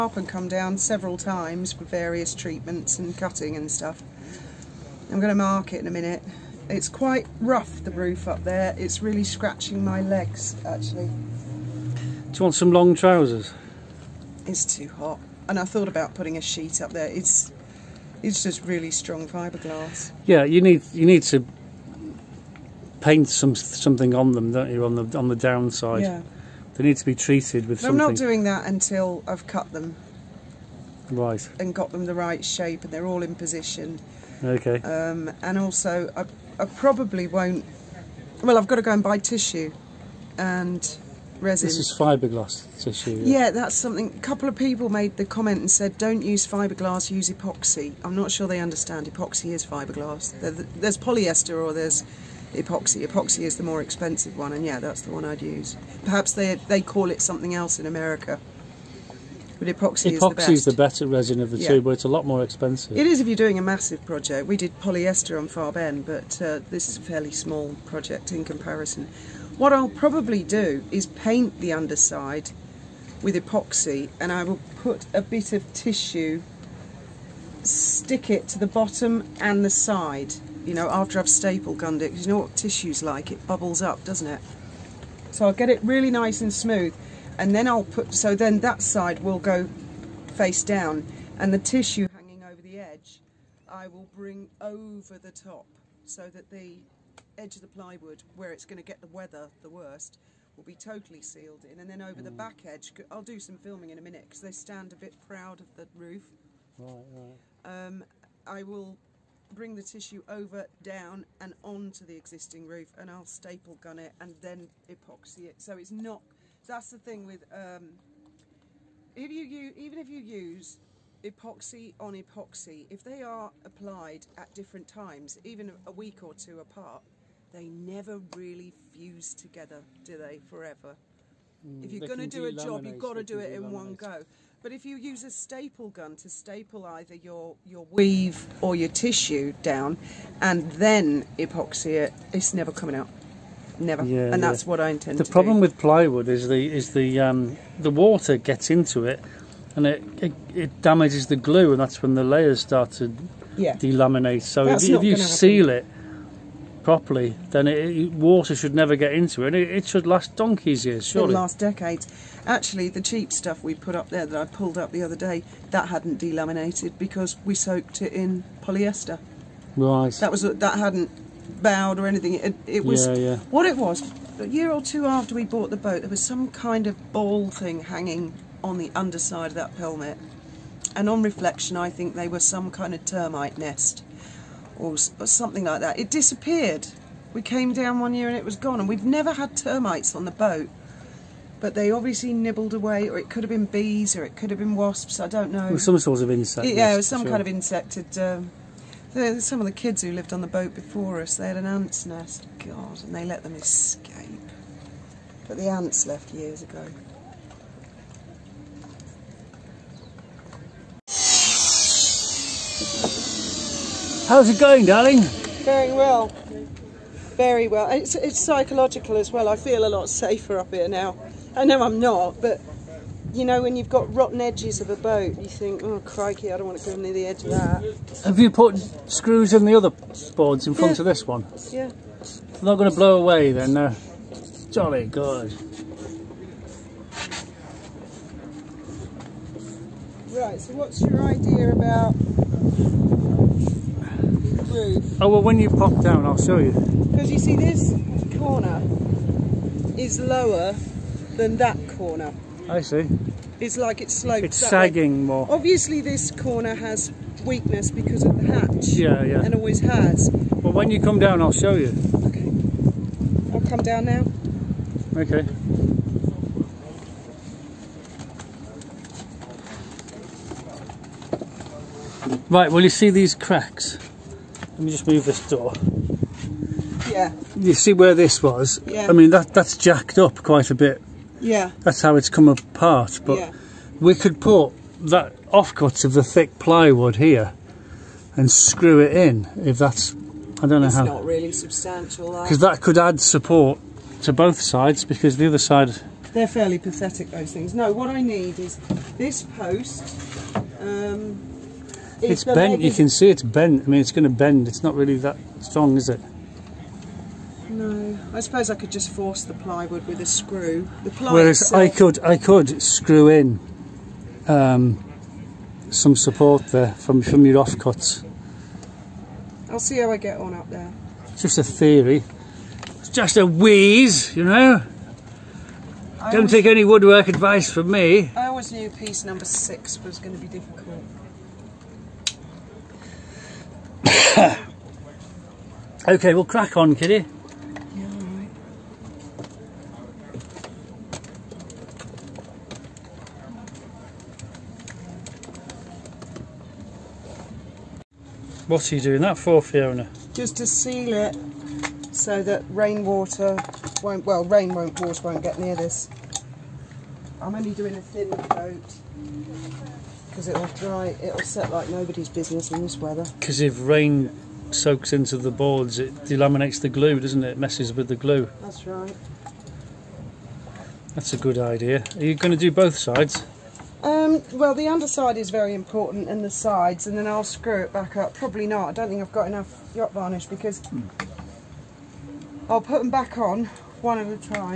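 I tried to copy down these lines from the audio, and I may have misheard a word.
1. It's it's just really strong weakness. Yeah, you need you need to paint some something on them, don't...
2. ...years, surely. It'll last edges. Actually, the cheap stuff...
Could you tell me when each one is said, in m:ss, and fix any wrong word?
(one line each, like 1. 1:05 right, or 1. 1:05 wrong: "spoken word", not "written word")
1. 0:17 wrong: "fiberglass", not "weakness"
2. 2:40 wrong: "decades", not "edges".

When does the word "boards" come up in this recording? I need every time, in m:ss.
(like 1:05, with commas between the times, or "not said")
3:50, 6:05.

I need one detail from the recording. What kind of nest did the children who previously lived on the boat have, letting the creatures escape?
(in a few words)
Ant's nest.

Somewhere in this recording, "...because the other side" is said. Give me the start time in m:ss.
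4:55.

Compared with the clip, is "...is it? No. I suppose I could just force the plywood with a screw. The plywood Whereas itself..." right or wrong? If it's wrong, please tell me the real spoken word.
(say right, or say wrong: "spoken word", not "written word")
right.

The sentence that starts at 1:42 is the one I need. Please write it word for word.
the back edge I'll do some filming in a minute because they stand a bit proud of the roof right, right.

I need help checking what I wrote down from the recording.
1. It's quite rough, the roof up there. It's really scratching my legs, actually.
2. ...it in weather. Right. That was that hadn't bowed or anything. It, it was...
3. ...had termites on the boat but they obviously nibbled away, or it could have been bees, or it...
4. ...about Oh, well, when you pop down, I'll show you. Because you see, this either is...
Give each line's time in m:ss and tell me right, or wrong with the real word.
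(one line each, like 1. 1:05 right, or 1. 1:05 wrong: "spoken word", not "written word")
1. 0:06 right
2. 2:48 wrong: "polyester", not "weather"
3. 3:09 right
4. 4:01 wrong: "corner", not "either".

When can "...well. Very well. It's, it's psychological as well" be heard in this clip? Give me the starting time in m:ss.
3:35.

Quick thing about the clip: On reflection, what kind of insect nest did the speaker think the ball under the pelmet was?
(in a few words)
Termite nest.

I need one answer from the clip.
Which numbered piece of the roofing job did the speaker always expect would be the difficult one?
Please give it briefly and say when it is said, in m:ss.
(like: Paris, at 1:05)
6, at 5:28.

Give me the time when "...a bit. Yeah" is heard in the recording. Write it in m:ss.
4:40.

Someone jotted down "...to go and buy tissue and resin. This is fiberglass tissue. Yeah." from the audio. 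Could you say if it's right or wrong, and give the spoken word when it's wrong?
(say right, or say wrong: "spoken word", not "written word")
right.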